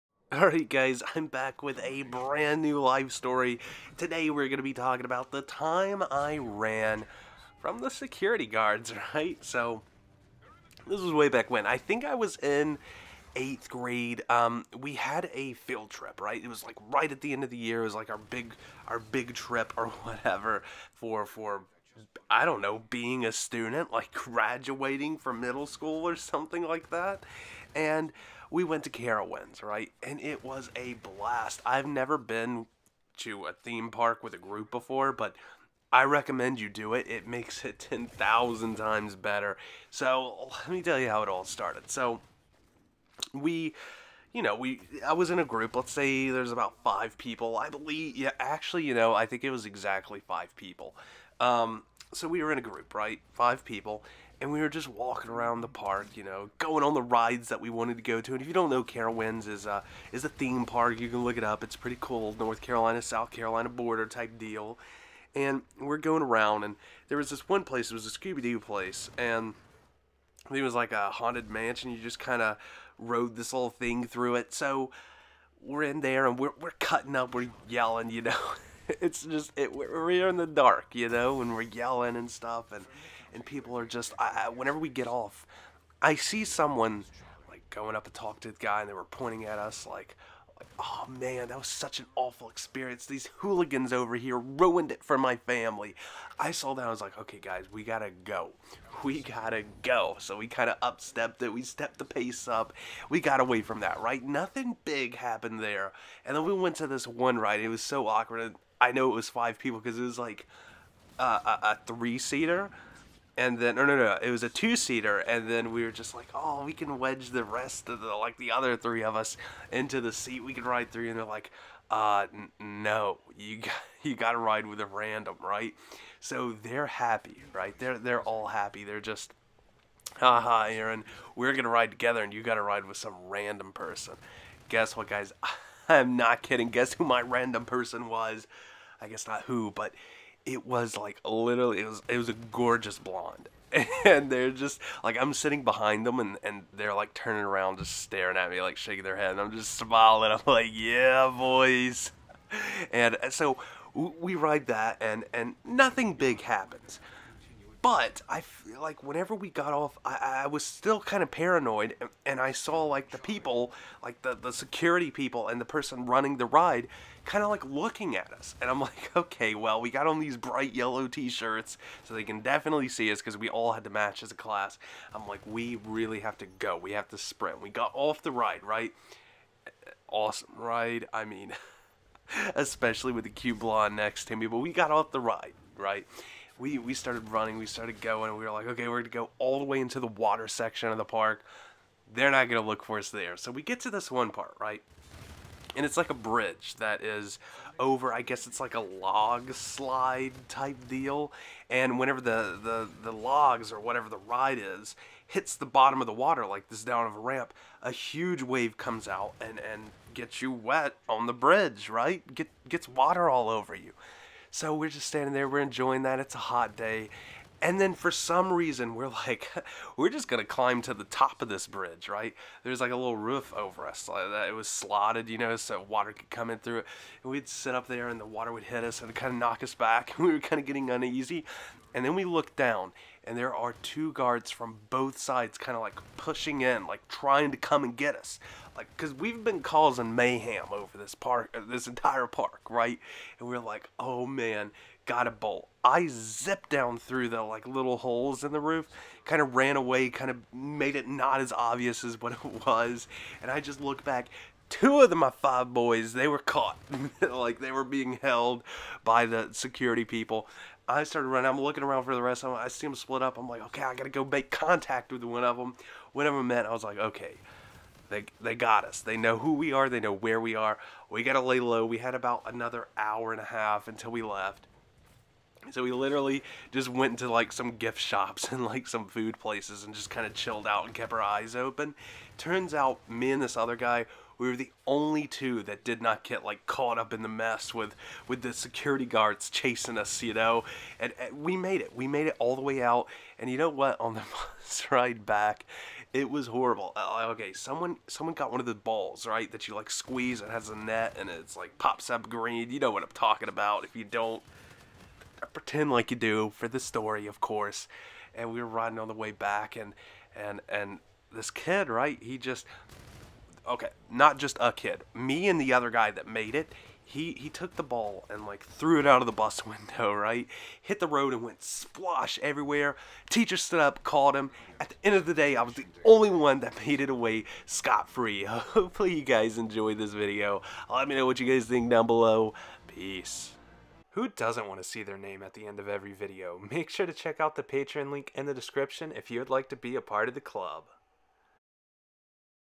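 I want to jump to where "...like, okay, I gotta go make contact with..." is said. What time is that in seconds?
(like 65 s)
263 s.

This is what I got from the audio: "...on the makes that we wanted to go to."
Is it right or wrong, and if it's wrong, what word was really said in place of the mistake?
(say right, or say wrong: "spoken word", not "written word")
wrong: "rides", not "makes".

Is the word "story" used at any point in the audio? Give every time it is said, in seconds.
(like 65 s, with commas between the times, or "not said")
3 s, 306 s.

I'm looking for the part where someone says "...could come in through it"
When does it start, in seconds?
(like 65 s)
226 s.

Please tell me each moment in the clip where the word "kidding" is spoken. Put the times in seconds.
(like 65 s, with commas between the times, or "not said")
136 s.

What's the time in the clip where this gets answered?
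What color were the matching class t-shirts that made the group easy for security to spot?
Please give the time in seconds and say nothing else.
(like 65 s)
170 s.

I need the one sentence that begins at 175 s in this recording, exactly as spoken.
I'm like, we really have to go.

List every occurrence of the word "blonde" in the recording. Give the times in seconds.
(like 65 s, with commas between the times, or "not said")
142 s, 183 s.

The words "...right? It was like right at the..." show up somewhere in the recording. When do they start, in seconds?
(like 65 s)
16 s.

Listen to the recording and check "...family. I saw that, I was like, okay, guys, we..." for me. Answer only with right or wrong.
right.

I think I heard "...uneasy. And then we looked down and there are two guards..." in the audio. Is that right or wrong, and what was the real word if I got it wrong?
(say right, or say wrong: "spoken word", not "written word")
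right.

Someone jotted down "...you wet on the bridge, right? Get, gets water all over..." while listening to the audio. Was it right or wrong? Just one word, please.
right.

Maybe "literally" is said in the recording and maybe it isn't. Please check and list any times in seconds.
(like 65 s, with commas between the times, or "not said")
141 s, 275 s.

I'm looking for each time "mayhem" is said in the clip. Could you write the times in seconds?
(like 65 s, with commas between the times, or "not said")
240 s.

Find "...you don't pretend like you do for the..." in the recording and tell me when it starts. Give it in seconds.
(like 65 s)
303 s.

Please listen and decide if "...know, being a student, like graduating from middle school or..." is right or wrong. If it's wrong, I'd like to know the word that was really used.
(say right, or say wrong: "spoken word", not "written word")
right.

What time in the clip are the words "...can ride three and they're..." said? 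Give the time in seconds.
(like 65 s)
120 s.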